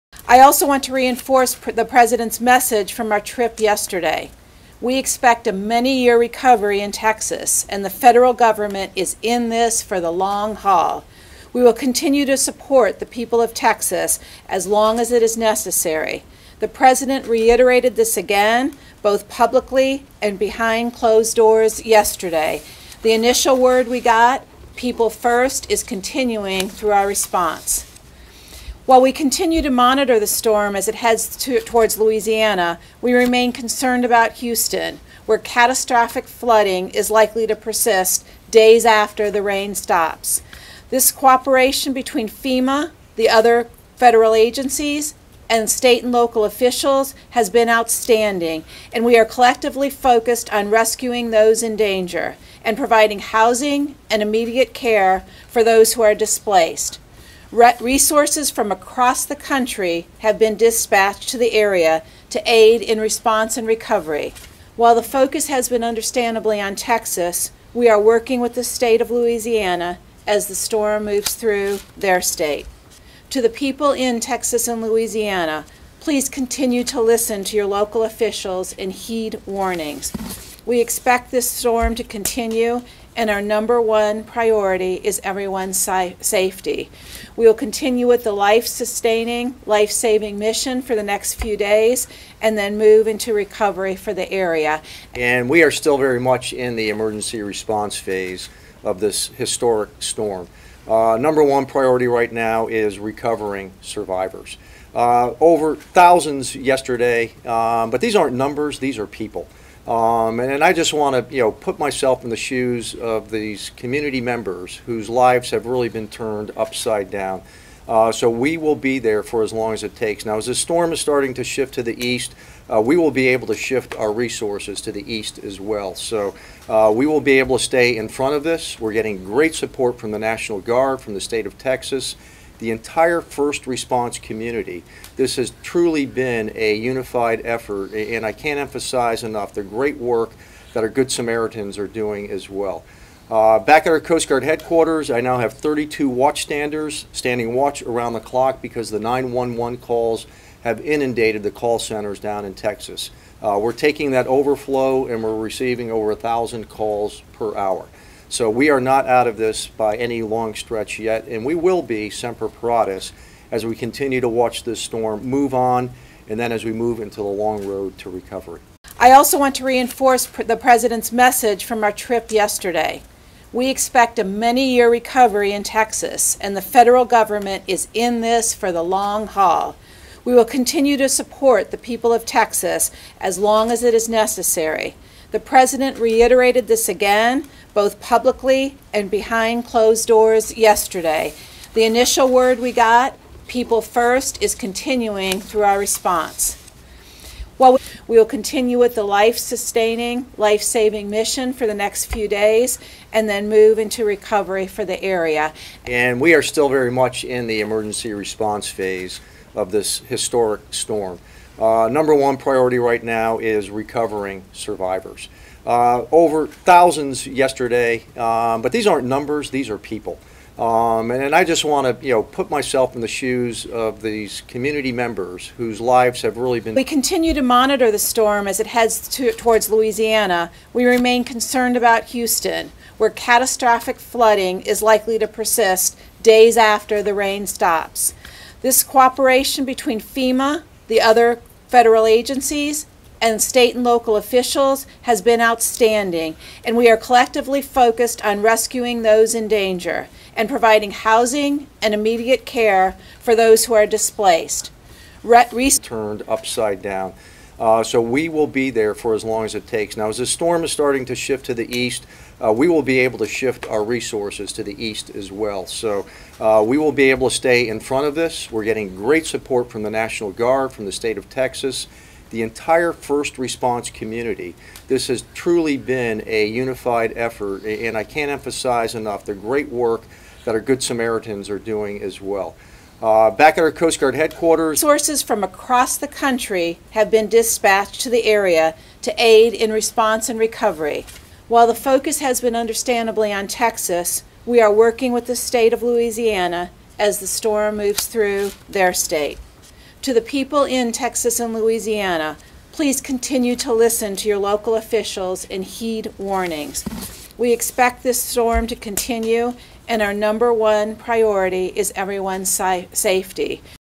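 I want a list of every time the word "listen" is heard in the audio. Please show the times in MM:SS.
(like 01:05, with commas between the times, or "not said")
01:17, 05:03.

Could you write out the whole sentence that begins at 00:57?
Re resources from across the country have been dispatched to the area to aid in response and recovery.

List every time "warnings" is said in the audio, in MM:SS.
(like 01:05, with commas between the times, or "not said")
01:19, 05:06.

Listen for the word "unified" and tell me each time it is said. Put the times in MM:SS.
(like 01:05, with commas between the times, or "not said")
02:16, 04:36.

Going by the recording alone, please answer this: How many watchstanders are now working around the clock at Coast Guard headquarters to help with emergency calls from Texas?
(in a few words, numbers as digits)
32.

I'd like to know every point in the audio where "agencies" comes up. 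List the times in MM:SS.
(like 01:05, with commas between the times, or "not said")
00:44, 04:02.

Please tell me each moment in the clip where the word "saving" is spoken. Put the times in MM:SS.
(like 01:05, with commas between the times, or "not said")
01:29, 03:20.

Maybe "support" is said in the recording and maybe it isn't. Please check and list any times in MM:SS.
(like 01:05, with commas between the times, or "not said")
00:12, 02:09, 03:01, 04:29.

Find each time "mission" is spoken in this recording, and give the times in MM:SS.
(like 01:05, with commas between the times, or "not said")
01:30, 03:21.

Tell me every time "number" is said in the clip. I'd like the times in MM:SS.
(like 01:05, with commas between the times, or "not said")
01:23, 01:41, 01:48, 03:31, 03:39, 05:10.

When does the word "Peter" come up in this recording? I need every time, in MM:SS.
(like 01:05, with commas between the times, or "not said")
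not said.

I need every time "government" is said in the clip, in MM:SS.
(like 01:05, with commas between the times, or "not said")
00:08, 02:57.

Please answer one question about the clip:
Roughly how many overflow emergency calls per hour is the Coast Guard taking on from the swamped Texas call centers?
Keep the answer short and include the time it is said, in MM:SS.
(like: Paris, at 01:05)
over 1,000, at 02:35.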